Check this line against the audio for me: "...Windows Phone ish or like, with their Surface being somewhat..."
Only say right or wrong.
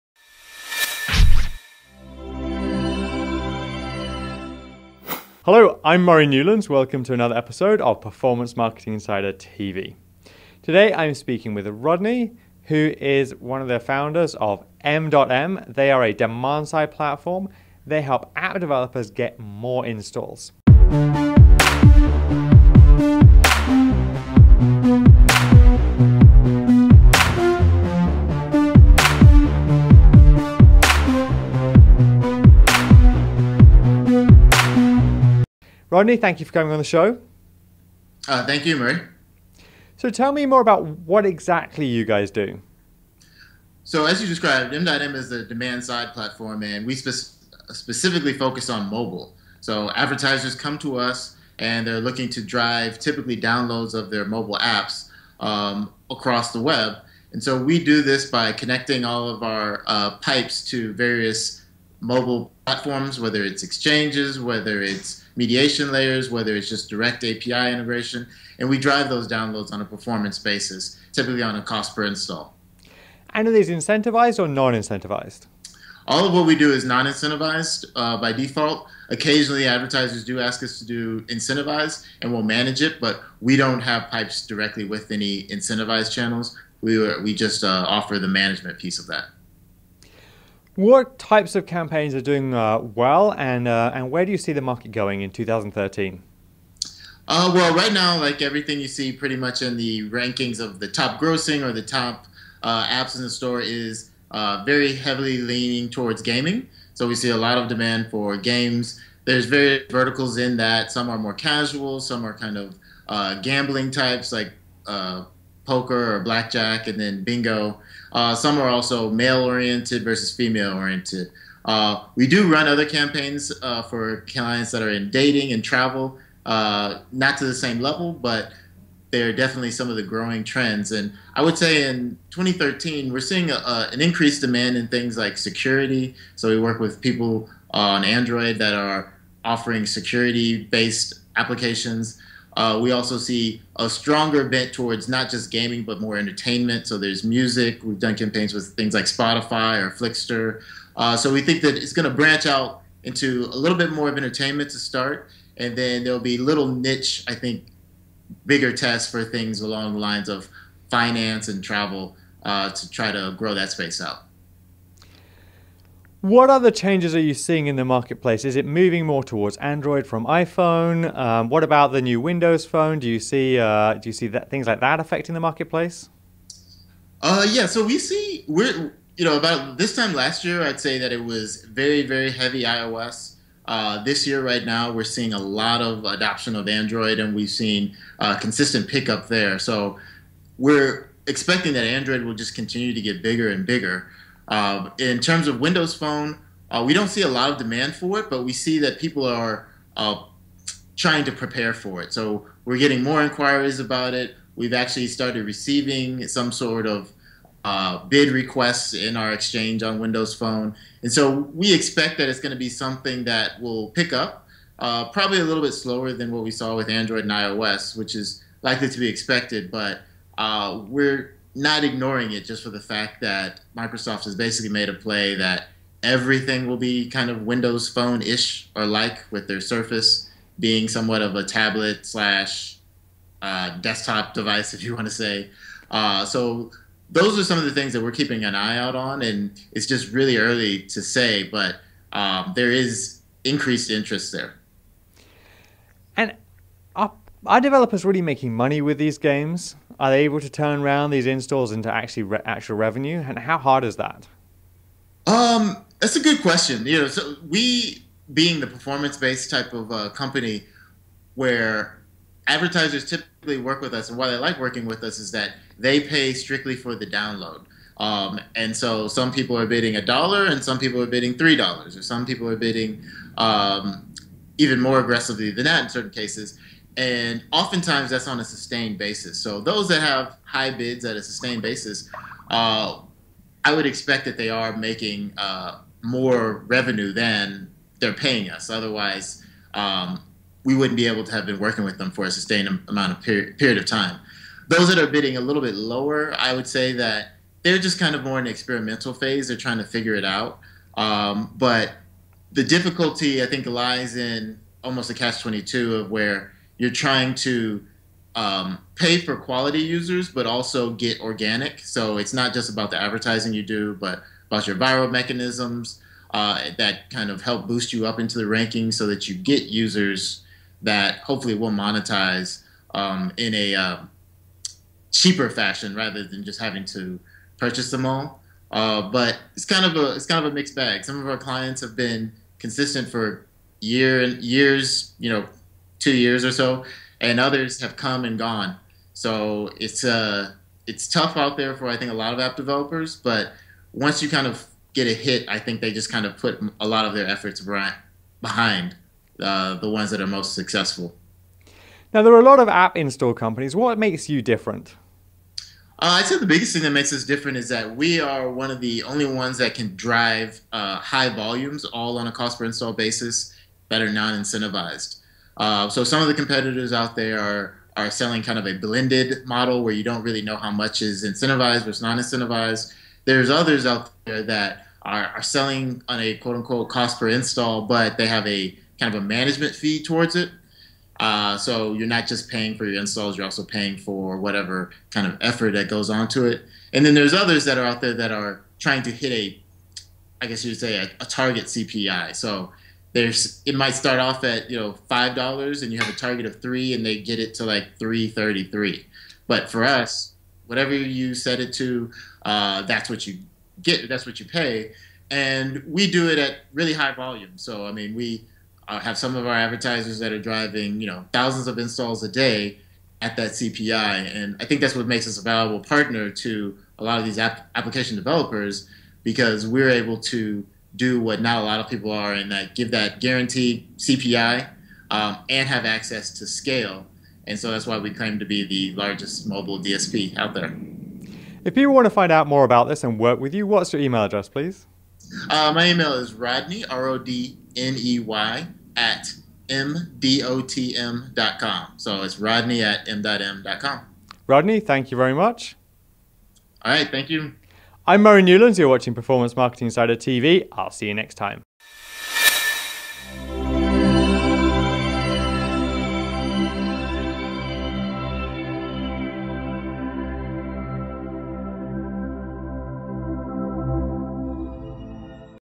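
right.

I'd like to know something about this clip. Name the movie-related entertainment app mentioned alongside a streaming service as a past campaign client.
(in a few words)
Flixster.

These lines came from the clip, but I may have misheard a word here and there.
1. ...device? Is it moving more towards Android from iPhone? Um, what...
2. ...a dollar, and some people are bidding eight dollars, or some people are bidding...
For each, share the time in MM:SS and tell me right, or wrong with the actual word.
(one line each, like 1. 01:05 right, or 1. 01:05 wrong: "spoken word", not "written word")
1. 02:47 wrong: "marketplace", not "device"
2. 04:29 wrong: "three", not "eight".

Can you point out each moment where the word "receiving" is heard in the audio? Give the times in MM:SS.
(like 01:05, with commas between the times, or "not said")
03:25.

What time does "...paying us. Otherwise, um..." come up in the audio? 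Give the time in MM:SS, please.
04:48.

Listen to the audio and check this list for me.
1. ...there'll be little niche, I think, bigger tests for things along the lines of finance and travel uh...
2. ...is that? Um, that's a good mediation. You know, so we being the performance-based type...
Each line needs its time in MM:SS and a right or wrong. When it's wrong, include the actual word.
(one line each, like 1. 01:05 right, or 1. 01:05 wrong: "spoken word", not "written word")
1. 02:36 right
2. 04:13 wrong: "question", not "mediation".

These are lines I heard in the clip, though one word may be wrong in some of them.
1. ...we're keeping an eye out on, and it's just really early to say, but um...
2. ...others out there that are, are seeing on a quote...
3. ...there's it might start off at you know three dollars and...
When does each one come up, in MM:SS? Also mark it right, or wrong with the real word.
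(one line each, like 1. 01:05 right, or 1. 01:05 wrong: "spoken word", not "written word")
1. 03:58 right
2. 06:13 wrong: "selling", not "seeing"
3. 06:33 wrong: "five", not "three".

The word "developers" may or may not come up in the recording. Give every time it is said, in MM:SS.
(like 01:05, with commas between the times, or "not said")
00:18, 04:07, 05:42, 06:58.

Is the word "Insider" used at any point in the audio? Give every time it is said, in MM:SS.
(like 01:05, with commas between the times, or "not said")
00:08, 07:29.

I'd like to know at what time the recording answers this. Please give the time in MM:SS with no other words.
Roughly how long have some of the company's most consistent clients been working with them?
05:36.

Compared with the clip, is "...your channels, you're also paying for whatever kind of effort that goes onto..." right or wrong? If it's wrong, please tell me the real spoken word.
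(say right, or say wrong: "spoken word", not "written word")
wrong: "installs", not "channels".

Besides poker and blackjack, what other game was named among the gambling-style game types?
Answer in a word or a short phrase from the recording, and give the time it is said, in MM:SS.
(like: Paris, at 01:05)
bingo, at 01:57.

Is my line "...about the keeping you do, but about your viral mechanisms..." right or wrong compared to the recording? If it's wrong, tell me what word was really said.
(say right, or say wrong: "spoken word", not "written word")
wrong: "advertising", not "keeping".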